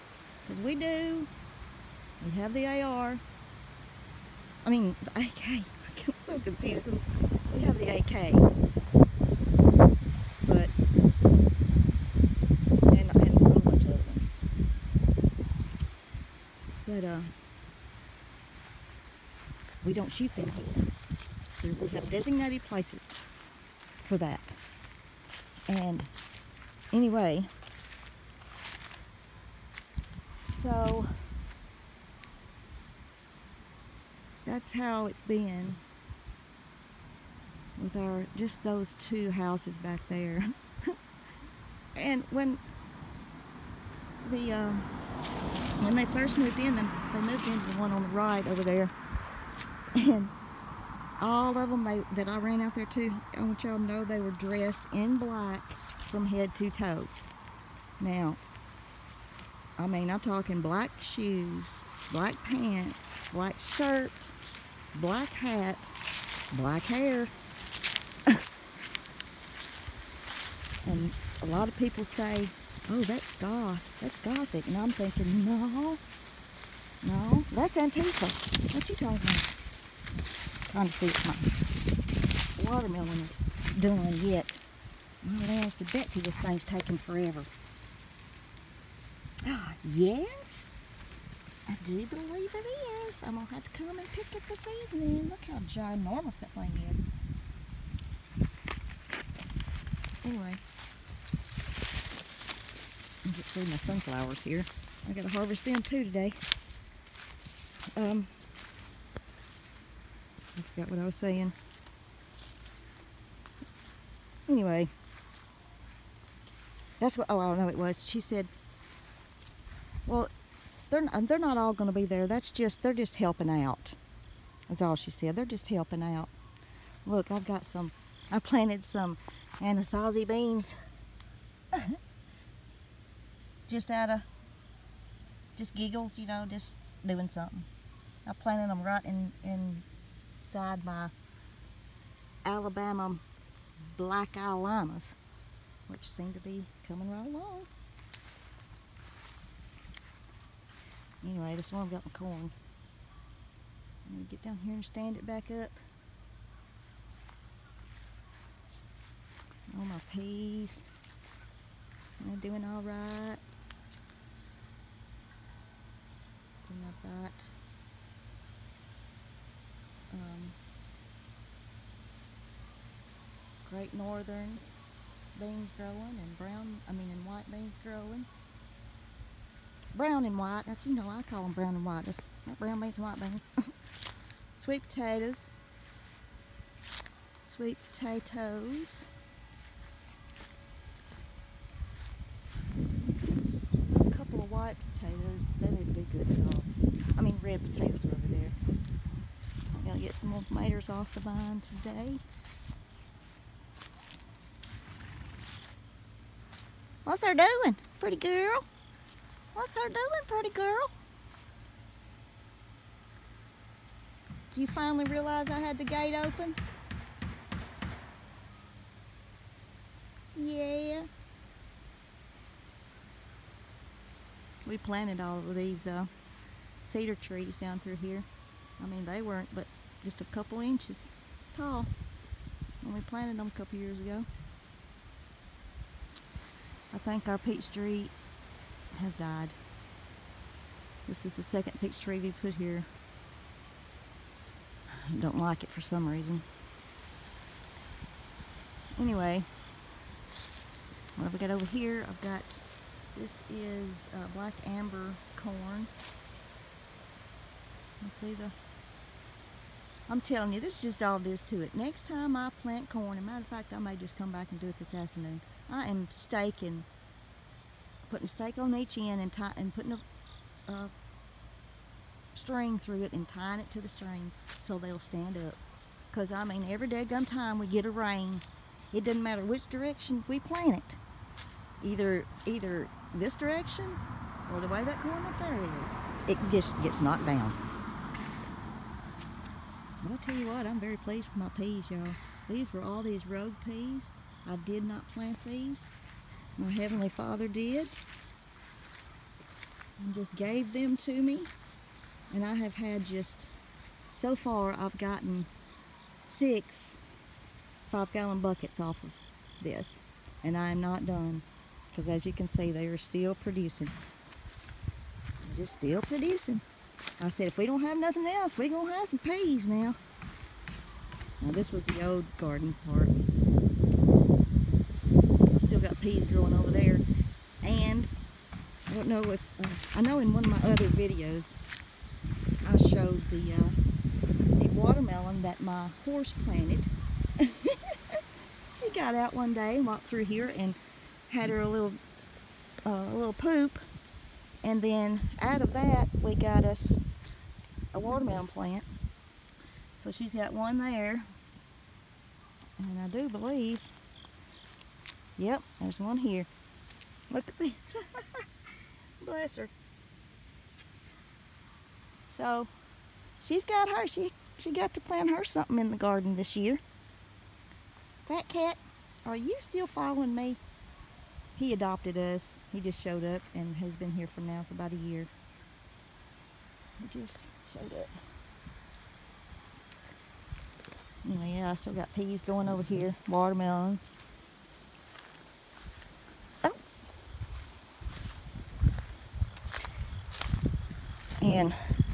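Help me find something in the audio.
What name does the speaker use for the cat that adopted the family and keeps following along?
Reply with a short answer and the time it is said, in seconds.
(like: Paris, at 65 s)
Fat Cat, at 368 s.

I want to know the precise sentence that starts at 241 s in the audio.
This is the second peach tree we put here.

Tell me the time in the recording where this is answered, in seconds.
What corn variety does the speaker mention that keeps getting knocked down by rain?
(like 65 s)
254 s.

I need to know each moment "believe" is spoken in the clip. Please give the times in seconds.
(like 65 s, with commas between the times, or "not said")
92 s, 353 s.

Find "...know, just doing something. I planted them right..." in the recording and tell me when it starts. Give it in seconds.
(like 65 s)
136 s.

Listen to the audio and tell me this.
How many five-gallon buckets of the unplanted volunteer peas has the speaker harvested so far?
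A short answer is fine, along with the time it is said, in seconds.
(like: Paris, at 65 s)
6, at 306 s.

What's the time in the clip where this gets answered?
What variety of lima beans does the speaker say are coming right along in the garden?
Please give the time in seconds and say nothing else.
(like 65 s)
142 s.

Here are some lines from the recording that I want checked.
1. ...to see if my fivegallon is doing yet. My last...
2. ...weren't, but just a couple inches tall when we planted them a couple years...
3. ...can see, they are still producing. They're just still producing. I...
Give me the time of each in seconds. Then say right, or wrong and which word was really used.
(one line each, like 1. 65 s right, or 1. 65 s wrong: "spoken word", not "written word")
1. 80 s wrong: "watermelon", not "fivegallon"
2. 229 s right
3. 312 s right.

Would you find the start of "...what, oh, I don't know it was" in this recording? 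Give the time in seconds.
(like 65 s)
117 s.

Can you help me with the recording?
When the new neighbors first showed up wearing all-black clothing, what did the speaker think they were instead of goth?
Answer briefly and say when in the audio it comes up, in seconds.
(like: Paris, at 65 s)
Antifa, at 77 s.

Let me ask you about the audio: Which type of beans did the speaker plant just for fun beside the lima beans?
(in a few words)
Anasazi beans.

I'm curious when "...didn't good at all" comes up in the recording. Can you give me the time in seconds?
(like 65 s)
195 s.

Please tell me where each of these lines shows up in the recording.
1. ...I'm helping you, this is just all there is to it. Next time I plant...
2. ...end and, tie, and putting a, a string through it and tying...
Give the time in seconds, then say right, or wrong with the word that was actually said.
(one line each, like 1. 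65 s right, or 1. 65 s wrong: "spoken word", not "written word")
1. 260 s wrong: "telling", not "helping"
2. 268 s right.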